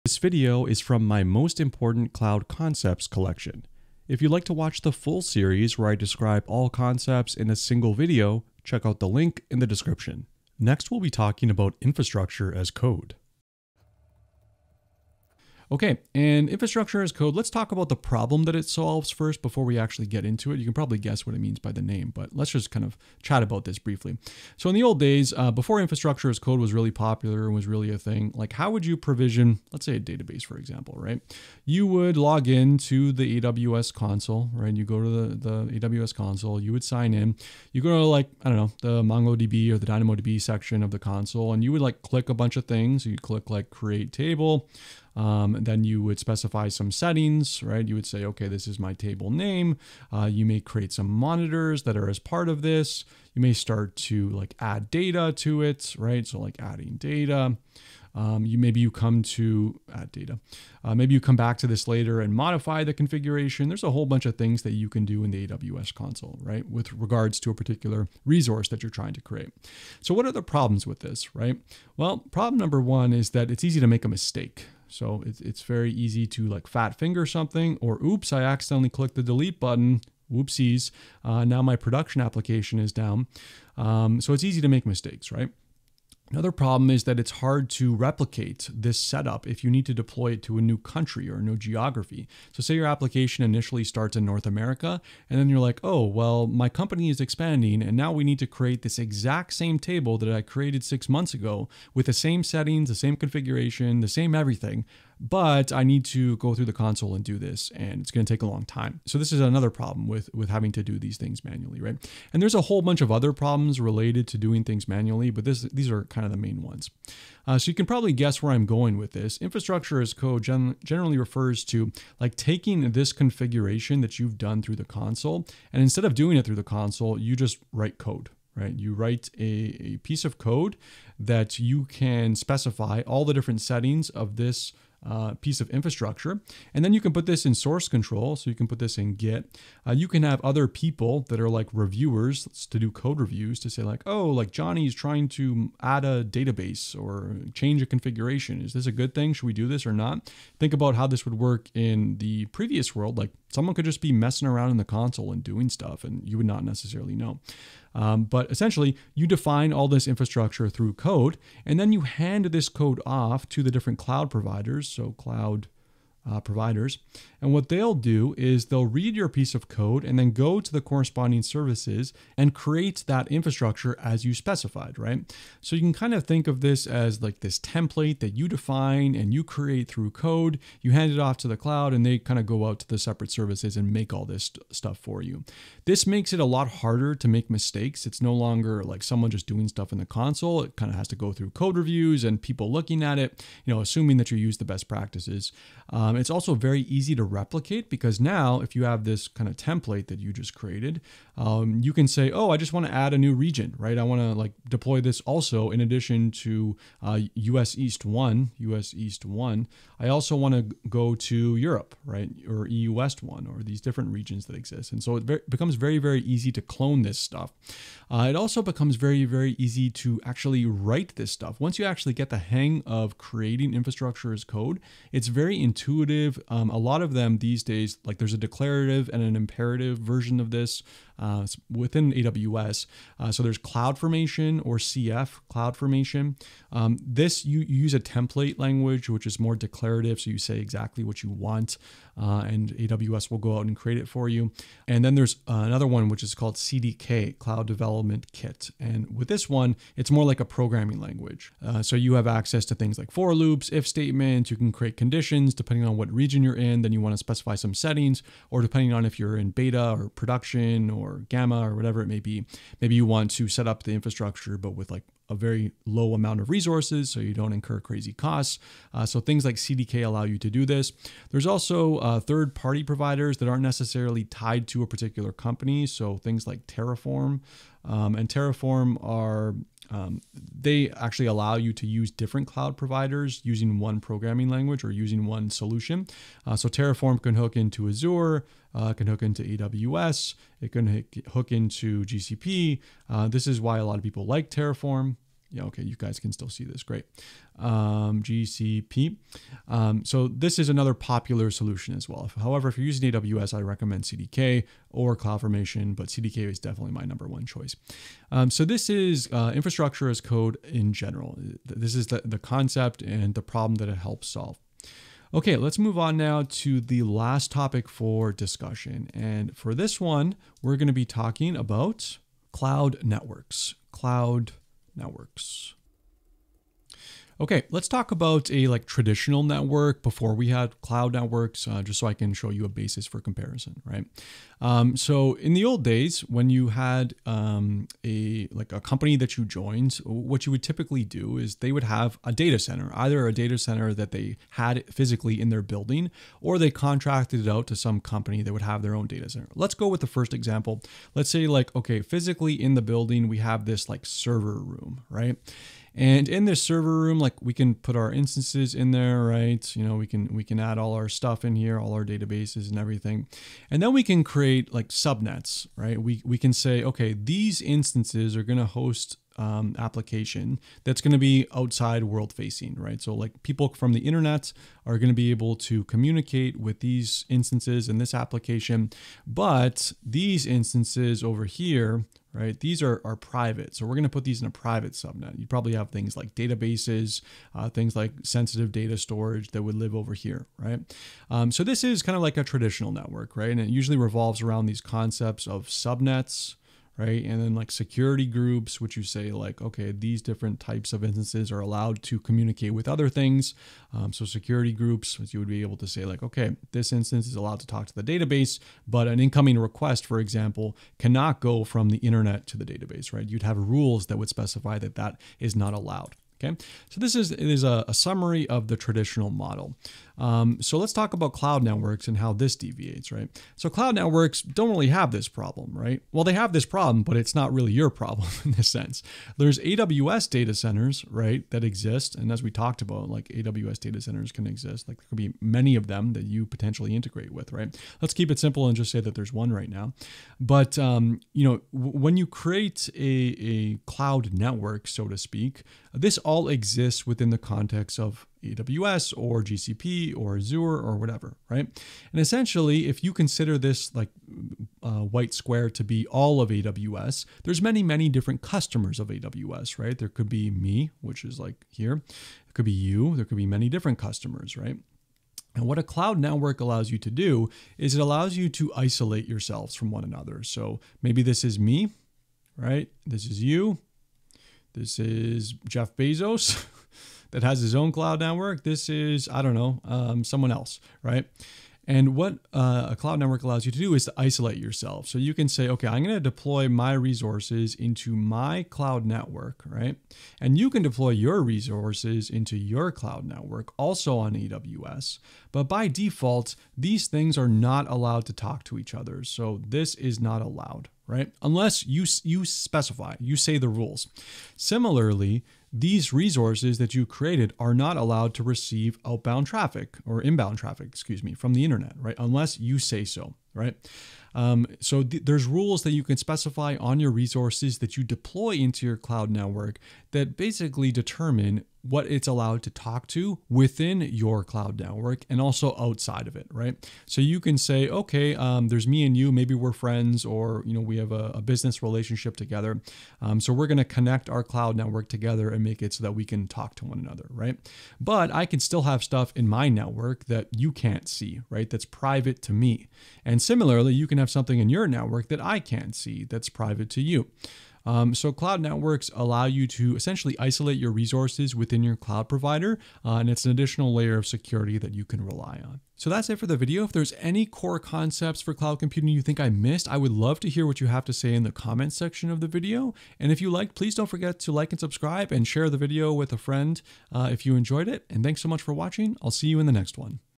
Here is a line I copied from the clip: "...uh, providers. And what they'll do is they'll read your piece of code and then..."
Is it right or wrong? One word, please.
right.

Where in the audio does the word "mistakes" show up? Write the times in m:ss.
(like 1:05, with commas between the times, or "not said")
1:14, 1:24, 3:07.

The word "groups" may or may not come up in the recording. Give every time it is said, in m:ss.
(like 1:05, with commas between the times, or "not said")
6:38, 6:44.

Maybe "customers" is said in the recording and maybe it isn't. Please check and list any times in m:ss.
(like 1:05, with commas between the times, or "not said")
7:38, 7:43.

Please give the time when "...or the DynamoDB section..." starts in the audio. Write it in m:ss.
0:39.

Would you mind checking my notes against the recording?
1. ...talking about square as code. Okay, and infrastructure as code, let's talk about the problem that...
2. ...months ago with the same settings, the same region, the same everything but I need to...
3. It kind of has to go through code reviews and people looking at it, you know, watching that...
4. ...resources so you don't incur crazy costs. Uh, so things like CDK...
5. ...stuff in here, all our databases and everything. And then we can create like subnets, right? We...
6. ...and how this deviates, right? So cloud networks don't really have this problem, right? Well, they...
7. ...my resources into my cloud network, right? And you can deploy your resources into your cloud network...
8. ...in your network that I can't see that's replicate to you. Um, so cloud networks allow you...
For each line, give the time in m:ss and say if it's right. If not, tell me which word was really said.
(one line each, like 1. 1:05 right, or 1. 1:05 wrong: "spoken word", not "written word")
1. 0:11 wrong: "infrastructure", not "square"
2. 1:41 wrong: "configuration", not "region"
3. 3:10 wrong: "assuming", not "watching"
4. 4:26 right
5. 6:01 right
6. 7:02 right
7. 8:06 right
8. 9:04 wrong: "private", not "replicate".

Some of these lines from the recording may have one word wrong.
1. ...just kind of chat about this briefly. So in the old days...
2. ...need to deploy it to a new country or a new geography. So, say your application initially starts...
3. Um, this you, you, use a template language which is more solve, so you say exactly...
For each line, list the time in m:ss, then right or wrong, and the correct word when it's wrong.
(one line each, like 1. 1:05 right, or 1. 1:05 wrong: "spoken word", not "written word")
1. 0:22 right
2. 1:29 right
3. 3:56 wrong: "declarative", not "solve".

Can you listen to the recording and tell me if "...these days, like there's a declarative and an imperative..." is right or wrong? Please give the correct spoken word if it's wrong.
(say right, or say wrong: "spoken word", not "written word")
right.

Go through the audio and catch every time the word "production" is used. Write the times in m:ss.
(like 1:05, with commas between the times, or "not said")
1:21, 4:20.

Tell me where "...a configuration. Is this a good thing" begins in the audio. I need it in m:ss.
2:27.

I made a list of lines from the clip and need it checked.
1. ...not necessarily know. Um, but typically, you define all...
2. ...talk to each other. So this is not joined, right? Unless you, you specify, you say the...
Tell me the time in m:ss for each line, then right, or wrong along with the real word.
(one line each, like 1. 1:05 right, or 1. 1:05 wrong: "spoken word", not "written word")
1. 2:36 wrong: "essentially", not "typically"
2. 8:18 wrong: "allowed", not "joined".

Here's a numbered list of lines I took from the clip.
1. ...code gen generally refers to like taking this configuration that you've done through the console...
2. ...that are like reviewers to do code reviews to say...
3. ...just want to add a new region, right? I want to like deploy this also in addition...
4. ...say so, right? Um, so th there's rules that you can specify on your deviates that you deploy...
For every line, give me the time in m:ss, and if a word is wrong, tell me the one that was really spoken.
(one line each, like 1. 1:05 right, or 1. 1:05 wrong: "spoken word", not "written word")
1. 2:00 right
2. 2:21 right
3. 3:22 right
4. 8:32 wrong: "resources", not "deviates".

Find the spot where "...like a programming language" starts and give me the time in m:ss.
4:10.